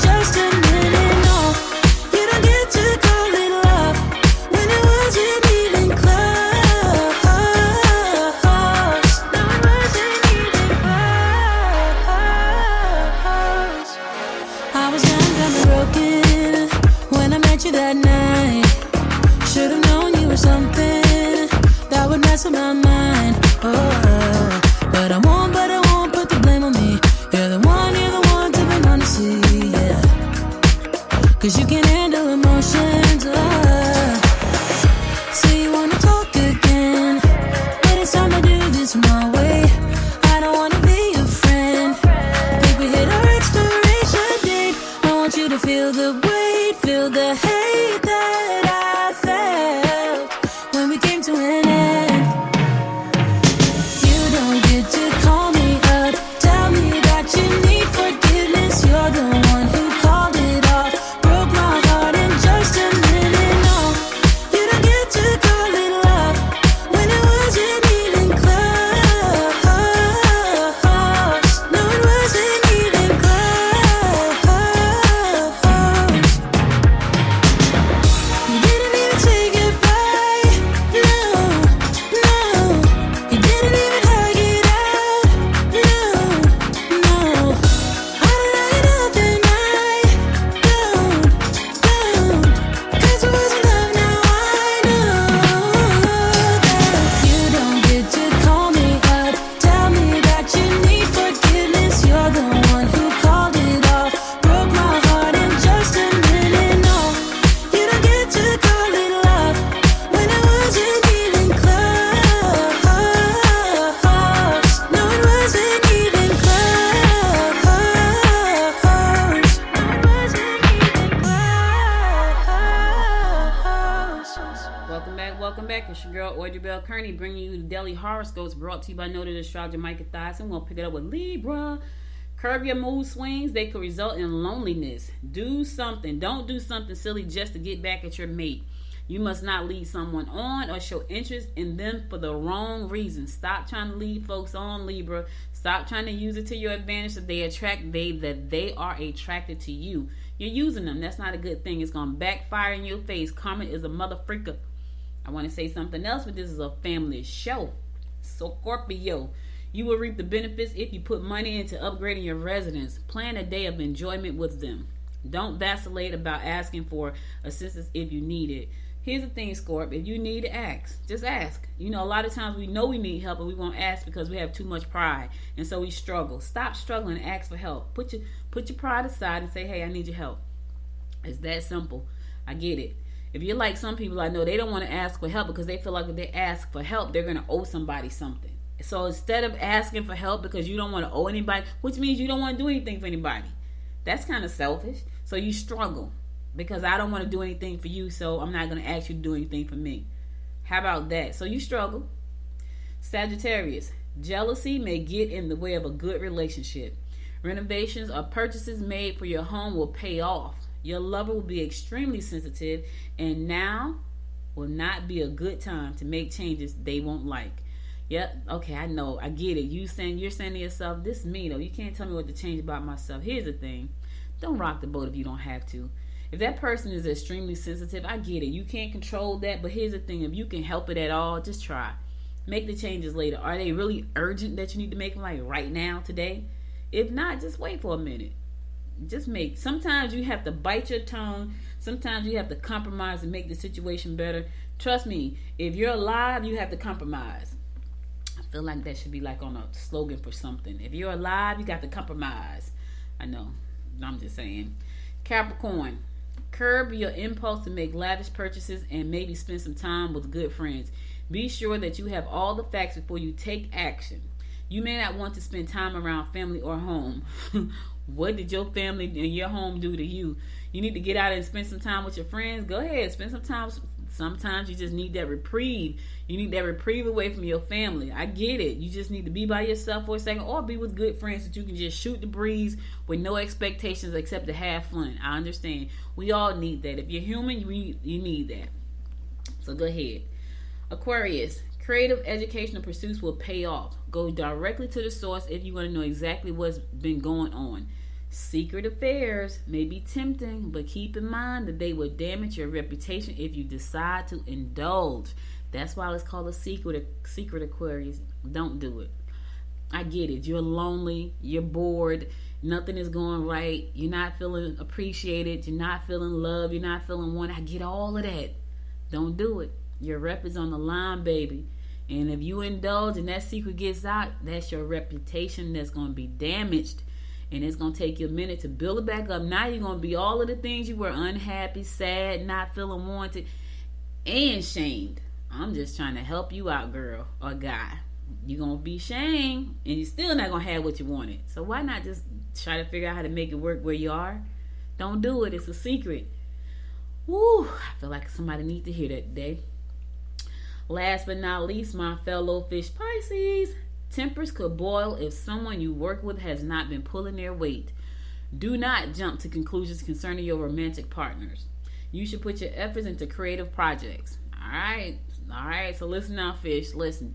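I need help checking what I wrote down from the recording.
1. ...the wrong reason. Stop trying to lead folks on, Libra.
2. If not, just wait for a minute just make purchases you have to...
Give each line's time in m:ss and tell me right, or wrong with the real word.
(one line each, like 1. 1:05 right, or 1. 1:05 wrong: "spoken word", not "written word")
1. 2:22 right
2. 3:56 wrong: "sometimes", not "purchases".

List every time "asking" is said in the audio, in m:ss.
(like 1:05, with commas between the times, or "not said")
2:46, 3:09.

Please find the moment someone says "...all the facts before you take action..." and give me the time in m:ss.
4:22.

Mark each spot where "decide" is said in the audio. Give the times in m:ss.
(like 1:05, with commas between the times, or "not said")
5:03.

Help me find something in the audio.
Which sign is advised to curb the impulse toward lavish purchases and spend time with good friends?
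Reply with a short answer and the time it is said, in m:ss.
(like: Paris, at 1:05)
Capricorn, at 4:15.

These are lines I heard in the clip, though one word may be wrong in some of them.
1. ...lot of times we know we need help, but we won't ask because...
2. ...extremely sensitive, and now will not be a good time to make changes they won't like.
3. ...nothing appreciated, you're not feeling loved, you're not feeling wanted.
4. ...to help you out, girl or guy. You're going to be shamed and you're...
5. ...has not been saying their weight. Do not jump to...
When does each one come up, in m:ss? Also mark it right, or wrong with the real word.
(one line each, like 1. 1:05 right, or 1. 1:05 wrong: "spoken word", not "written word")
1. 2:52 right
2. 3:31 right
3. 5:14 wrong: "feeling", not "nothing"
4. 5:36 right
5. 5:56 wrong: "pulling", not "saying".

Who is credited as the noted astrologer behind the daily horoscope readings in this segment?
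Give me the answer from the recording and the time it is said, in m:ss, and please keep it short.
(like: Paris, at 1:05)
Micah Thyssen, at 2:09.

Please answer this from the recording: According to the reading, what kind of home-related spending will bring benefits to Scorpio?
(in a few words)
upgrading your residence.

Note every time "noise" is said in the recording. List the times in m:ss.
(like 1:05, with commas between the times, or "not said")
not said.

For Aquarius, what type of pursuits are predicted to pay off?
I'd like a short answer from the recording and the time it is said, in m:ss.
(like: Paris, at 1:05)
creative educational pursuits, at 4:51.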